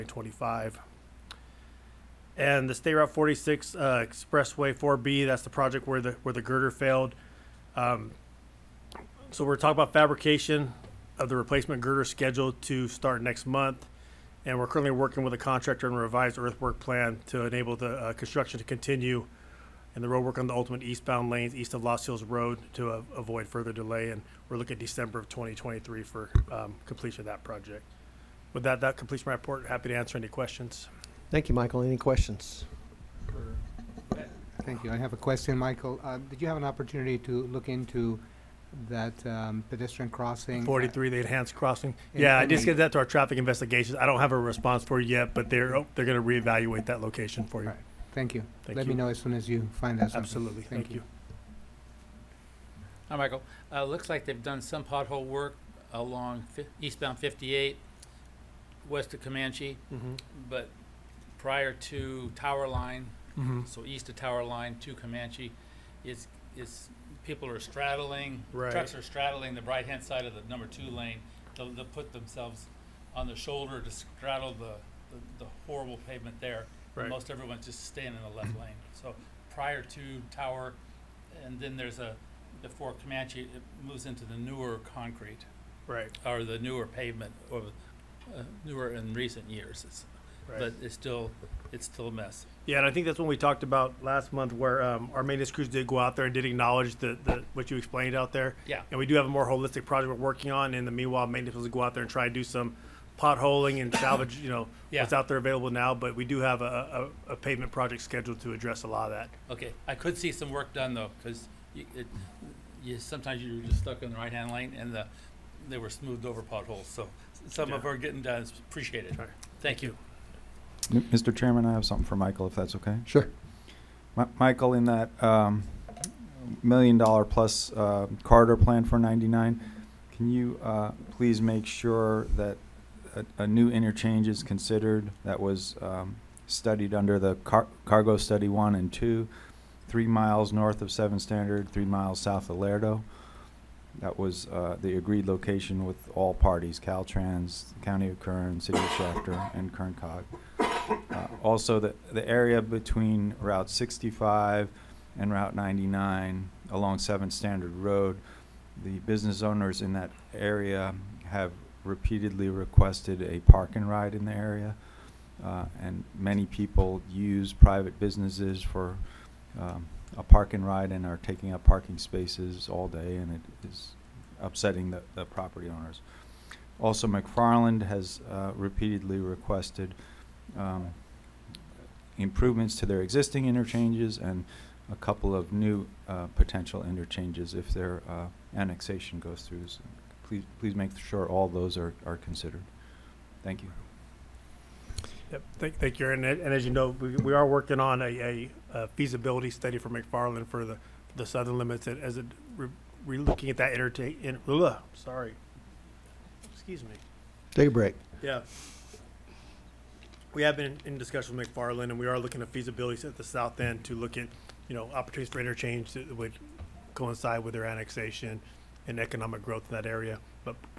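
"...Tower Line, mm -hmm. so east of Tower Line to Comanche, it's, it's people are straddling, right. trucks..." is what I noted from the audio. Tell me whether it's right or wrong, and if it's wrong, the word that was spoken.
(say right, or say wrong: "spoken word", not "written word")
right.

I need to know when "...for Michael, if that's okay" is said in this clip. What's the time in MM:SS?
02:02.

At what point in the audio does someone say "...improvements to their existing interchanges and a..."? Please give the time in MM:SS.
03:02.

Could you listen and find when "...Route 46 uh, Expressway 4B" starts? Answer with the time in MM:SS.
00:02.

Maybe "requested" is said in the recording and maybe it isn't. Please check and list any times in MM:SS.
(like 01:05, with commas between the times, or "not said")
02:42, 02:59.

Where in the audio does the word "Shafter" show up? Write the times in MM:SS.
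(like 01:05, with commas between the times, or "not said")
02:28.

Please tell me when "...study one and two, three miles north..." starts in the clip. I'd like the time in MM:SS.
02:18.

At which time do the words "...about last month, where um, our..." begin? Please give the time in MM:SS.
01:33.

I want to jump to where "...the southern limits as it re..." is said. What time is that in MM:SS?
03:21.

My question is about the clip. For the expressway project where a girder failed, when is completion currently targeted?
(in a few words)
December 2023.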